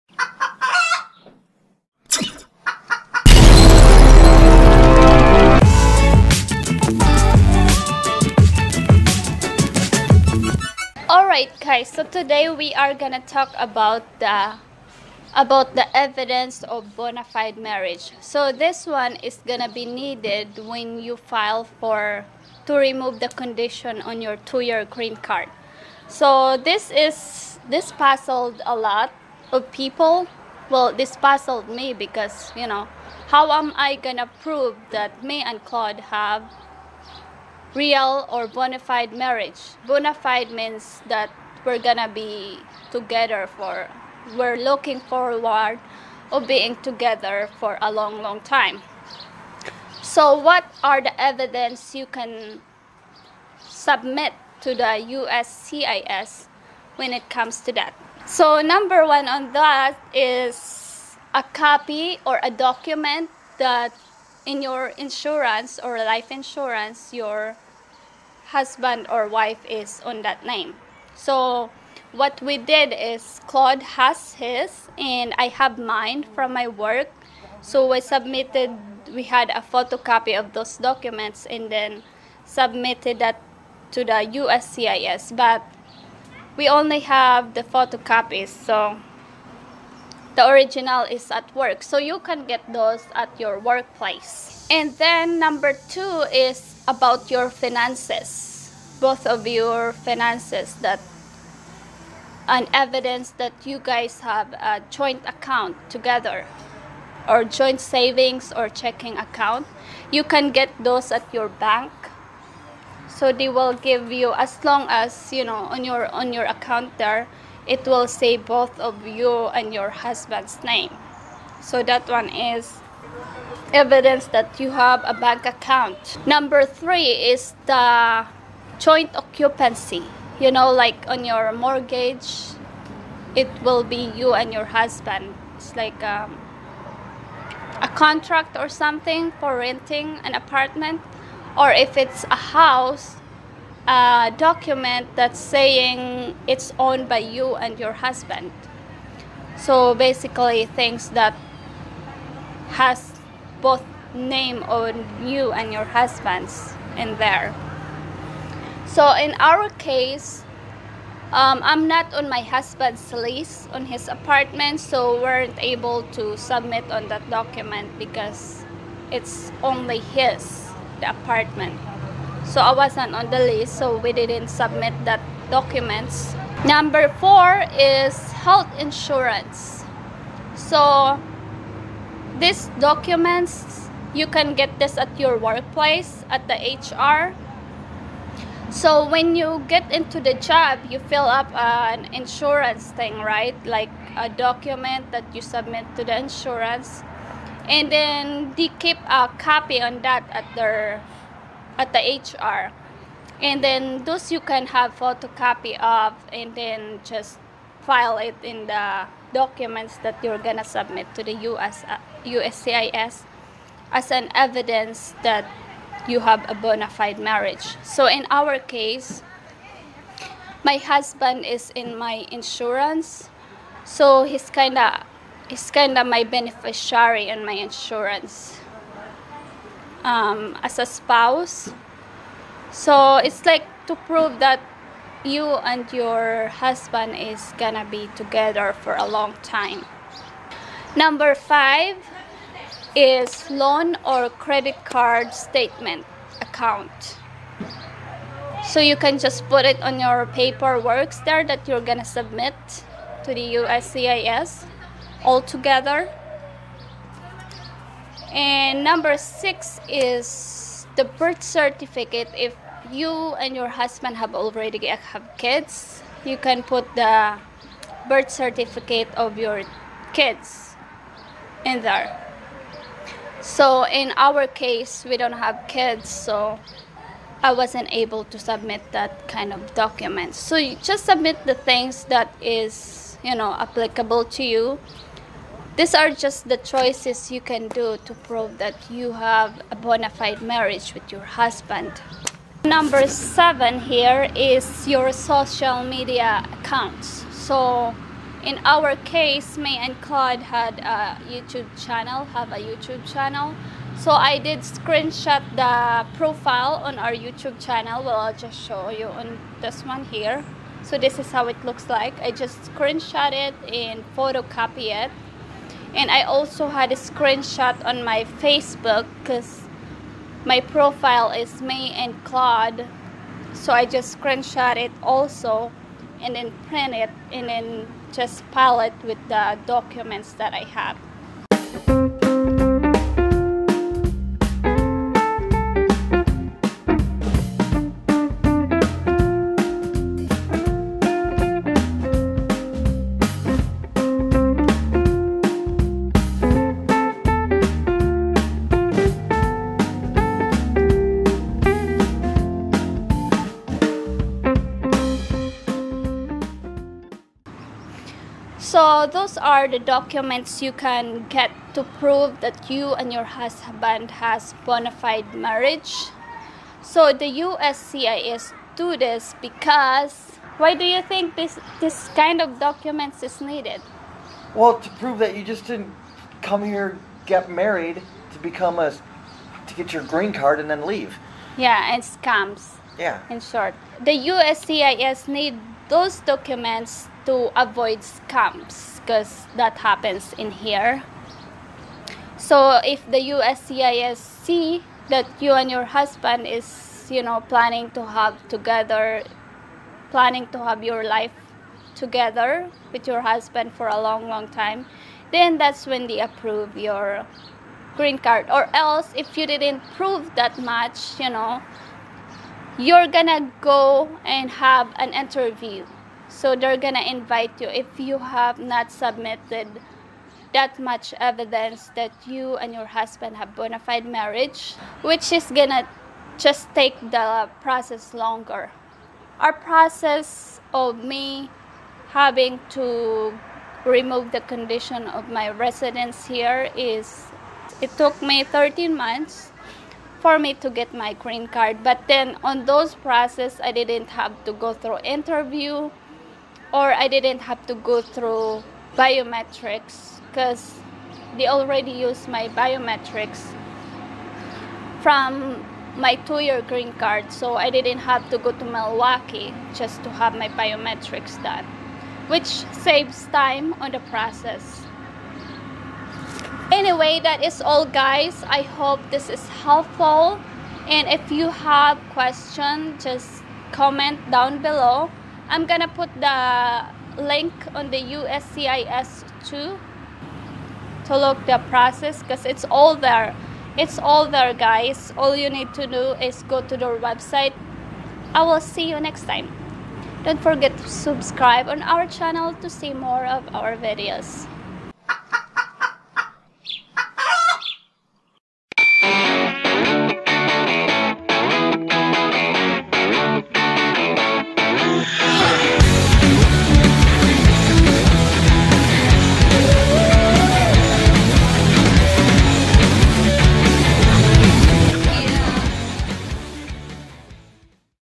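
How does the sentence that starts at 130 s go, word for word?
You know, like on your mortgage, it will be you and your husband.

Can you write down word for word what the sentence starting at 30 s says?
Well, this puzzled me because you know how am I gonna prove that me and Claude have real or bona fide marriage?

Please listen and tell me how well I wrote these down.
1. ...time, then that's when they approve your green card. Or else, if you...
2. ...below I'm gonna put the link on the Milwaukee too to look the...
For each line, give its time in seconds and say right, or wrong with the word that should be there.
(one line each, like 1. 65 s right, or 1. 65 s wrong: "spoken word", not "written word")
1. 404 s right
2. 474 s wrong: "USCIS", not "Milwaukee".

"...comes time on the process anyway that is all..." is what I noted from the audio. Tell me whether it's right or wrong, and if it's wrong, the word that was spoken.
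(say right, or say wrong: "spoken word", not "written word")
wrong: "saves", not "comes".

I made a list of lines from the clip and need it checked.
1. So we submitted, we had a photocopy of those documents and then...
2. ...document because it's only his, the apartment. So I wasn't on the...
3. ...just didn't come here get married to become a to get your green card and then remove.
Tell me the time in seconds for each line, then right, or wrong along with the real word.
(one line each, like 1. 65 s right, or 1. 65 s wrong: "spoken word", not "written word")
1. 77 s right
2. 167 s right
3. 375 s wrong: "leave", not "remove".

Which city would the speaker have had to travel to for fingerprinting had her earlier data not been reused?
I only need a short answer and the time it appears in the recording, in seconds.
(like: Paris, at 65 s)
Milwaukee, at 458 s.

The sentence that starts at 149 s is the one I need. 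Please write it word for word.
So basically, things that has both name on you and your husband's in there.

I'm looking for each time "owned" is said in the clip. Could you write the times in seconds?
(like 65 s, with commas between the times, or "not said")
146 s.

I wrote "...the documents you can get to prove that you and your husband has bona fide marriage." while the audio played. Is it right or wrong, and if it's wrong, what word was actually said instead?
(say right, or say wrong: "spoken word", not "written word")
right.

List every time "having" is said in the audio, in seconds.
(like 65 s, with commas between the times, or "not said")
432 s.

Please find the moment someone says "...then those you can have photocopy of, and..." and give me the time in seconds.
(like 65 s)
203 s.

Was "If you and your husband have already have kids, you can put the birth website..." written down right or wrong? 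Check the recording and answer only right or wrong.
wrong.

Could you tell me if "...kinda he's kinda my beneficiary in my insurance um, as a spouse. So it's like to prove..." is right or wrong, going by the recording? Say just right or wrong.
right.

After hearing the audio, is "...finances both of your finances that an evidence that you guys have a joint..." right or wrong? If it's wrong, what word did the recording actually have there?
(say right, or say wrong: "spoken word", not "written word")
right.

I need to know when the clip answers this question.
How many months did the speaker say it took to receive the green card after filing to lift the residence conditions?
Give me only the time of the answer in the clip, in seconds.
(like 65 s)
438 s.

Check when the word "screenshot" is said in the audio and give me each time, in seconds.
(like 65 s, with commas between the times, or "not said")
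304 s, 312 s, 316 s, 324 s.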